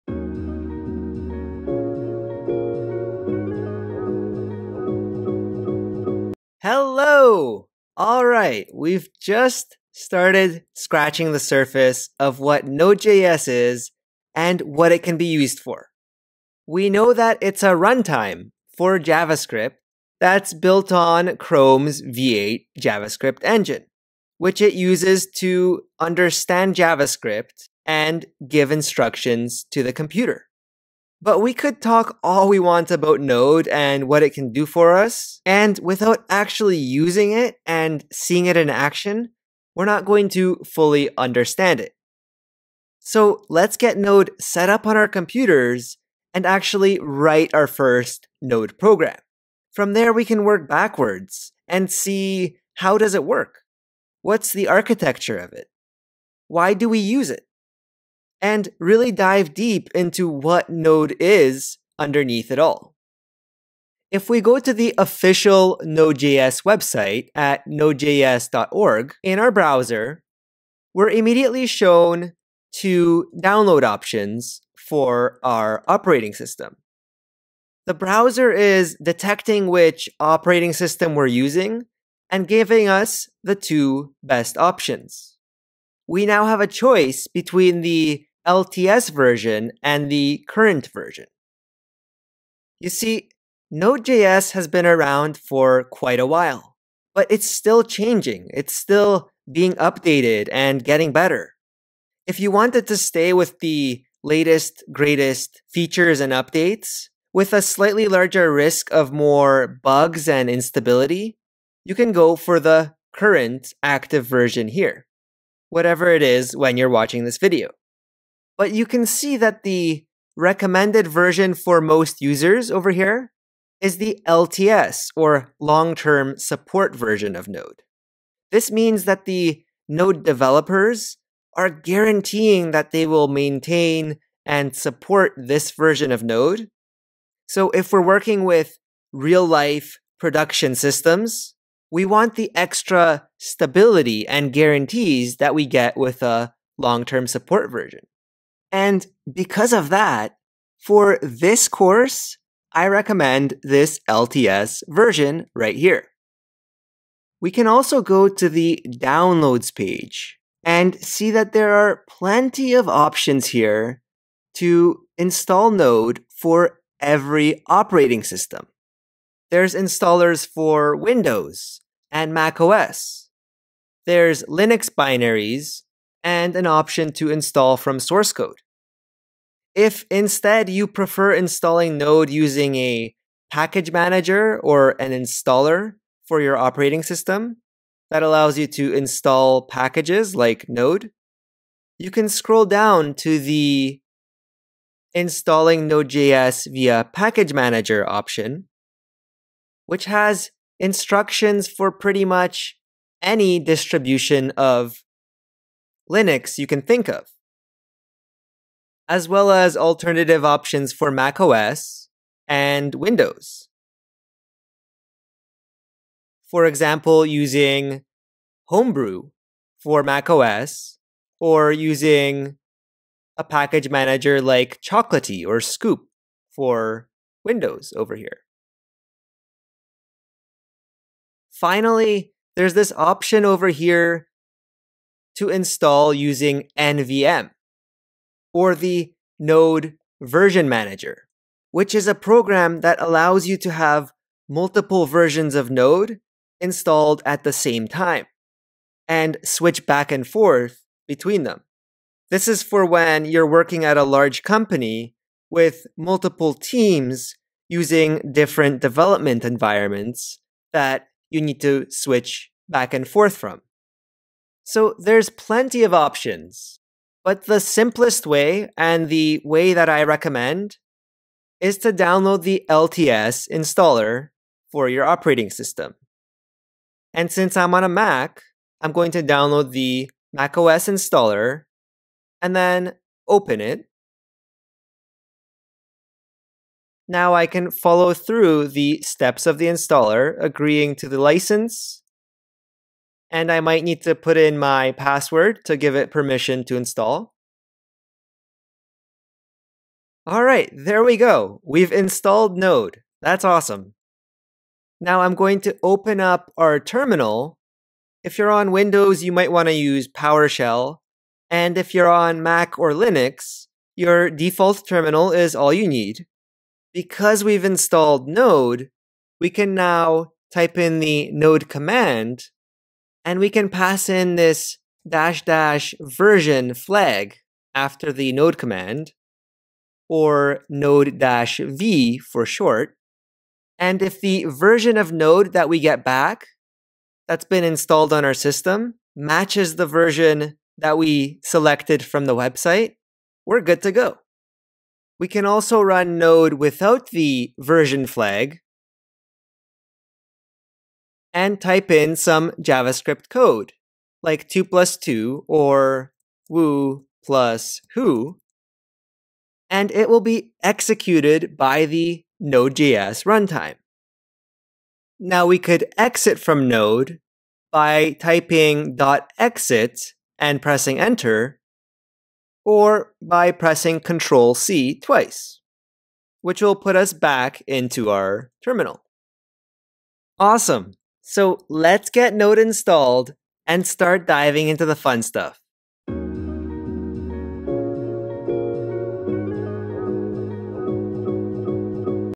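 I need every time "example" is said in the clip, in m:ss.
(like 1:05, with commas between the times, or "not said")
3:36.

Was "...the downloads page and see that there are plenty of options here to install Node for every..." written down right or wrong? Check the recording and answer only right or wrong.
right.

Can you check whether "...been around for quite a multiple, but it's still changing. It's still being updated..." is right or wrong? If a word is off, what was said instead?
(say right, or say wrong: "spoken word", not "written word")
wrong: "while", not "multiple".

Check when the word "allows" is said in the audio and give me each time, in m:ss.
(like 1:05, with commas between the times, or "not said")
3:08, 4:03.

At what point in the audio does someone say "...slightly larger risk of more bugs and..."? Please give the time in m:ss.
1:47.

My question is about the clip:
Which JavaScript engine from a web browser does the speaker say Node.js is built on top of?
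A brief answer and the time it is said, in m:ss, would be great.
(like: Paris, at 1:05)
Chrome's V8, at 0:21.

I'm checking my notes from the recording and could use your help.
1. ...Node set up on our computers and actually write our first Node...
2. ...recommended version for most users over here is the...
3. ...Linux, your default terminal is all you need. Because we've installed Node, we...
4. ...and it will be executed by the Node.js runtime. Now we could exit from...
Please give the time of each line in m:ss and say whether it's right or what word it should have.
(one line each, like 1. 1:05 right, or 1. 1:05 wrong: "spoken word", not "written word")
1. 0:43 right
2. 2:00 right
3. 5:12 right
4. 5:59 right.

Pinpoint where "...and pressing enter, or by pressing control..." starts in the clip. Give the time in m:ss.
6:10.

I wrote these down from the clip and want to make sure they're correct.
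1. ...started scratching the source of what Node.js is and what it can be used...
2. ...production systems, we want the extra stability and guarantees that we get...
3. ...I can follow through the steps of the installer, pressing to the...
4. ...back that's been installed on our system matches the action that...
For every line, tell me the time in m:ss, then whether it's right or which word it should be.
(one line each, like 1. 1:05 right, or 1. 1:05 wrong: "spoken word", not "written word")
1. 0:09 wrong: "surface", not "source"
2. 2:20 right
3. 4:47 wrong: "agreeing", not "pressing"
4. 5:36 wrong: "version", not "action".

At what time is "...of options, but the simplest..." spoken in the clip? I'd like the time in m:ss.
4:25.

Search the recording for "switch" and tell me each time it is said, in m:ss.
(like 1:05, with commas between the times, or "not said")
4:09, 4:21.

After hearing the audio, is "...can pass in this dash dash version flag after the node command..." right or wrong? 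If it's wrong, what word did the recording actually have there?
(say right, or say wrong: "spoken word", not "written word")
right.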